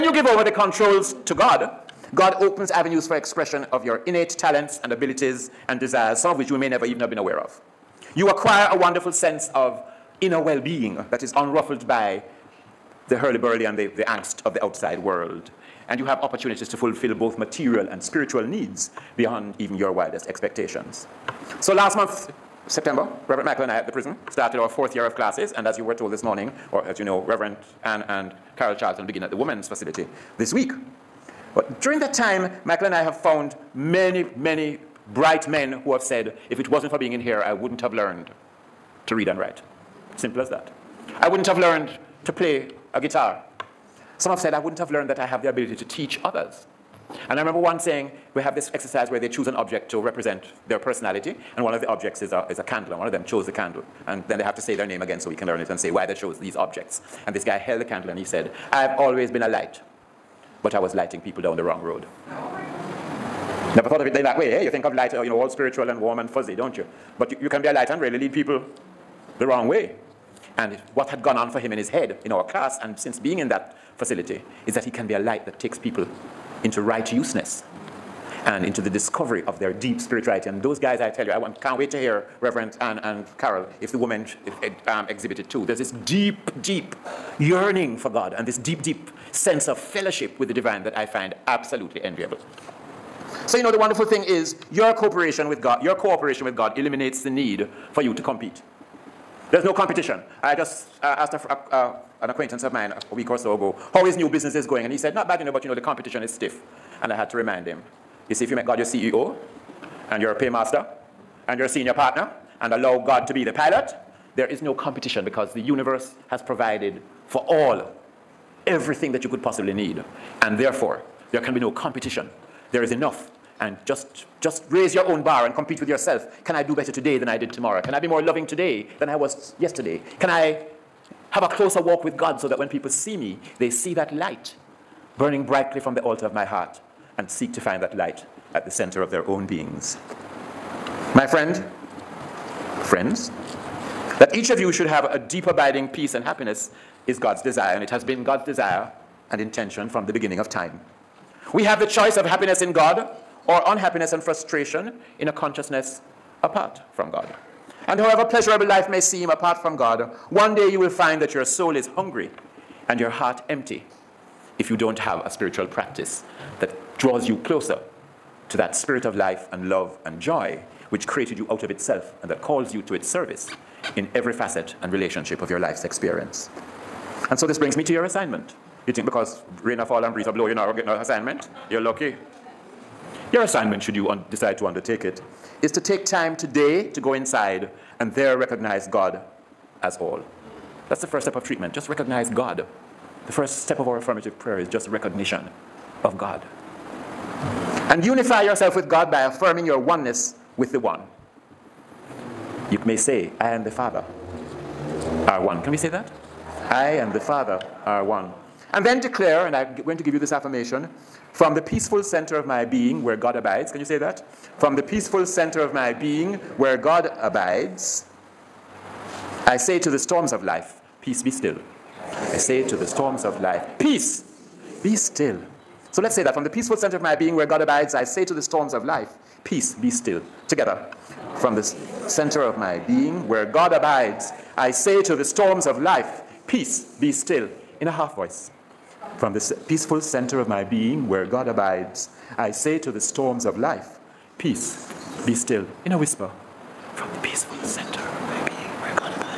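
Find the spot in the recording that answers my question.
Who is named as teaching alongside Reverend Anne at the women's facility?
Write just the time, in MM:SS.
00:28.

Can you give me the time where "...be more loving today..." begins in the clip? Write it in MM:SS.
02:07.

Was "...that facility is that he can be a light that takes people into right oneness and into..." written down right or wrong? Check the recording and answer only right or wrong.
wrong.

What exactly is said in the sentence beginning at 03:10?
That's the first step of treatment.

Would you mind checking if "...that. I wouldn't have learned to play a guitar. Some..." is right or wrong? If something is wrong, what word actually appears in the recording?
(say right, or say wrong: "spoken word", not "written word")
right.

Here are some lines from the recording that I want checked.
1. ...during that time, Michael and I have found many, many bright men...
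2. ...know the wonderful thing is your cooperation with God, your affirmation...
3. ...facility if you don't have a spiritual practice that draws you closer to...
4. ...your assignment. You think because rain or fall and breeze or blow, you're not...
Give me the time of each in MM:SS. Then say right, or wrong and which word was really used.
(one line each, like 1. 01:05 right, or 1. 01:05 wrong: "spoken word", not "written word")
1. 00:31 right
2. 01:33 wrong: "cooperation", not "affirmation"
3. 02:43 wrong: "empty", not "facility"
4. 02:57 right.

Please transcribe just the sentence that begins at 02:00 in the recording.
And therefore, there can be no competition.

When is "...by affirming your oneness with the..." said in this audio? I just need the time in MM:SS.
03:19.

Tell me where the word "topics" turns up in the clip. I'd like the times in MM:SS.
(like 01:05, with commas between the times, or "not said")
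not said.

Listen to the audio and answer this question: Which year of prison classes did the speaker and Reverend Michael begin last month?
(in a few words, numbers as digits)
fourth year.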